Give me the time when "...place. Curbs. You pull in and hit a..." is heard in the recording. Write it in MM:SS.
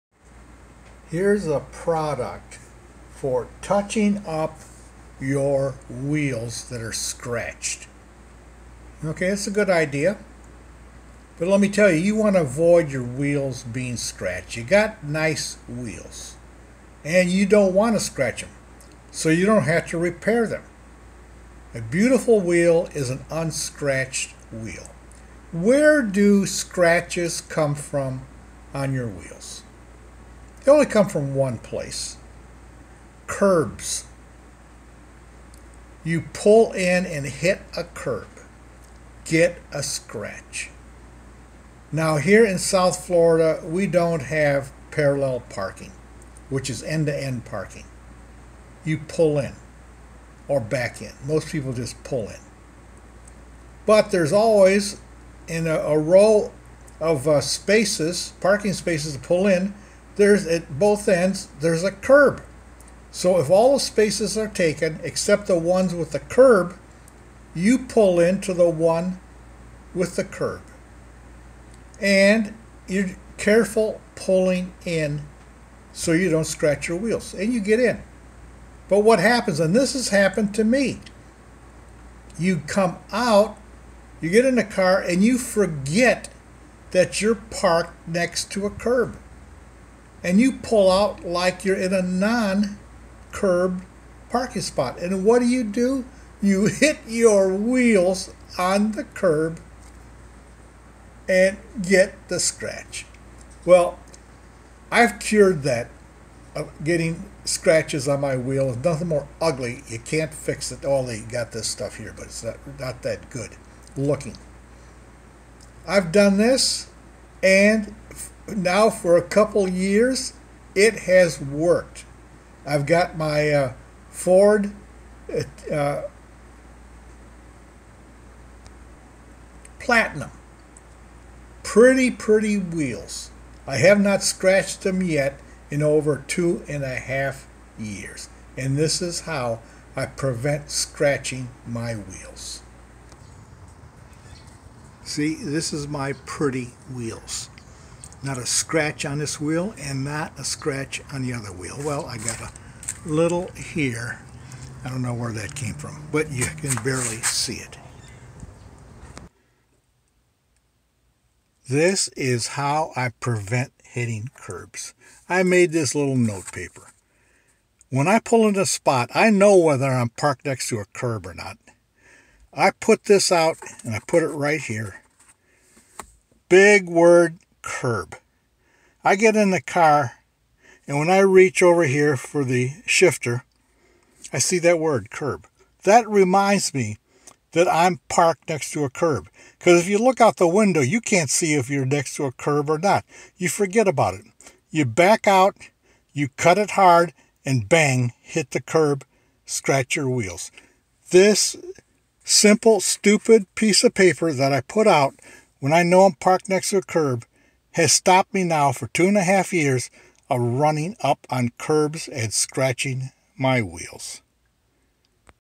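00:31.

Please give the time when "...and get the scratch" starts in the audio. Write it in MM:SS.
01:41.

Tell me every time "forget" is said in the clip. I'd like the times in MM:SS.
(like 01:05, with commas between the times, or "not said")
01:25, 03:13.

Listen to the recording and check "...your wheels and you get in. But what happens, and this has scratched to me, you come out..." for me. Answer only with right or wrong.
wrong.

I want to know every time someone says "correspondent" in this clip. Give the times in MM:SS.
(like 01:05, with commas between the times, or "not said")
not said.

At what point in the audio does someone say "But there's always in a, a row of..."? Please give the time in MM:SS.
00:53.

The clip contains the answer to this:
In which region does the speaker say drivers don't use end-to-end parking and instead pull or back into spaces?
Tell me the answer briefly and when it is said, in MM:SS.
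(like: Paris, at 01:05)
South Florida, at 00:42.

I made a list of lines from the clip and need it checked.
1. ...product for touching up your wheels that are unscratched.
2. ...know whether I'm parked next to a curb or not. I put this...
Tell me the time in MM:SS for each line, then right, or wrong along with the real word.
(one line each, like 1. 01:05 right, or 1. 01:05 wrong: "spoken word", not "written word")
1. 00:01 wrong: "scratched", not "unscratched"
2. 02:49 right.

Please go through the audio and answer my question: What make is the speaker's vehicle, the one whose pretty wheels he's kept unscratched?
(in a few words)
Ford.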